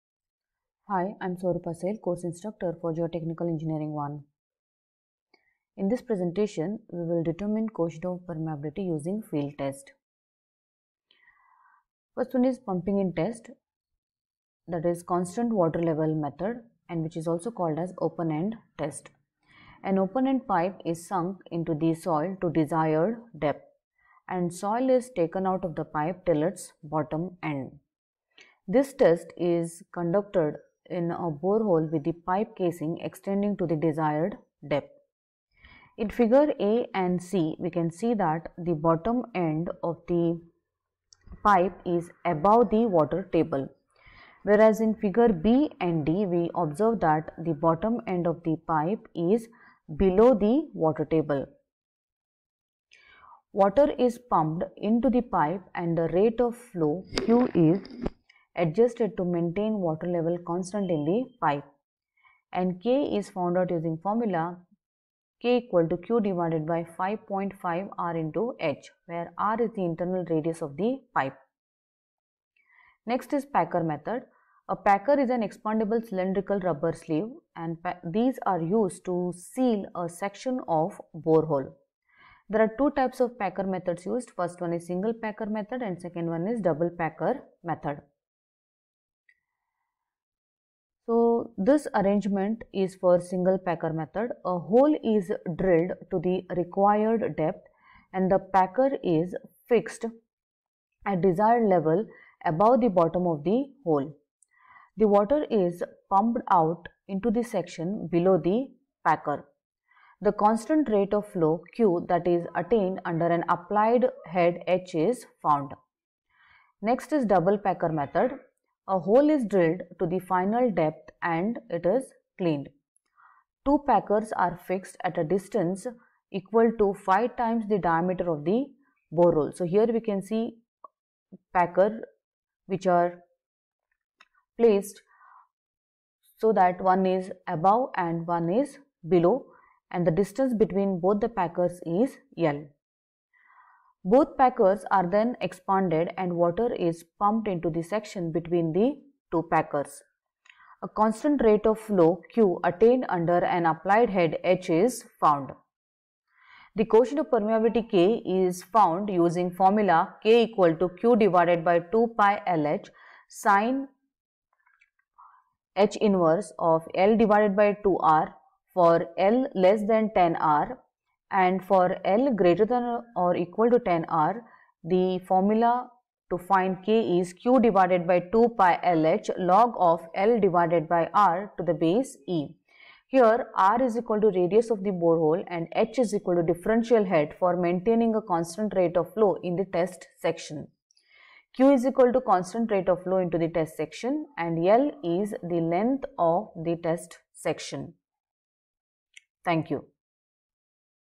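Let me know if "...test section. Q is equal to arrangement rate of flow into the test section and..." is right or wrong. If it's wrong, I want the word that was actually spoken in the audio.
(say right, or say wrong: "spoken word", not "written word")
wrong: "constant", not "arrangement".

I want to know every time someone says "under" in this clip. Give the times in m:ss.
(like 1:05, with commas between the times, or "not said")
1:53, 2:33.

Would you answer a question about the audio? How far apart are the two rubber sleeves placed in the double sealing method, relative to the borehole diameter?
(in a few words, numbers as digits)
5 times the diameter.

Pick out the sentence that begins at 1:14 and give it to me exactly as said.
A packer is an expandable cylindrical rubber sleeve and these are used to seal a section of borehole.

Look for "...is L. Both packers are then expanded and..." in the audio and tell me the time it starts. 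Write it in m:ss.
2:21.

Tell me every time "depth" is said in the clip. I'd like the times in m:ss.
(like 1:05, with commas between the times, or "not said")
0:23, 0:34, 1:37, 2:00.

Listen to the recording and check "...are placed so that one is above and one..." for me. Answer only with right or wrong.
right.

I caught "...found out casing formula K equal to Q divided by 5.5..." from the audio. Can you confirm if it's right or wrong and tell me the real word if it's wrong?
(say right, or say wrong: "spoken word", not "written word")
wrong: "using", not "casing".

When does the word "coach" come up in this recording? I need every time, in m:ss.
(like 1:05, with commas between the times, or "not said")
0:07.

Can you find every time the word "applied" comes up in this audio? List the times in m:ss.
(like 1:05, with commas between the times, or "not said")
1:53, 2:33.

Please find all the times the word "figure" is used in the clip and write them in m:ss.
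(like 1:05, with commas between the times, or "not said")
0:36, 0:44.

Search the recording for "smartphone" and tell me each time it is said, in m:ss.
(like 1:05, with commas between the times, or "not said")
not said.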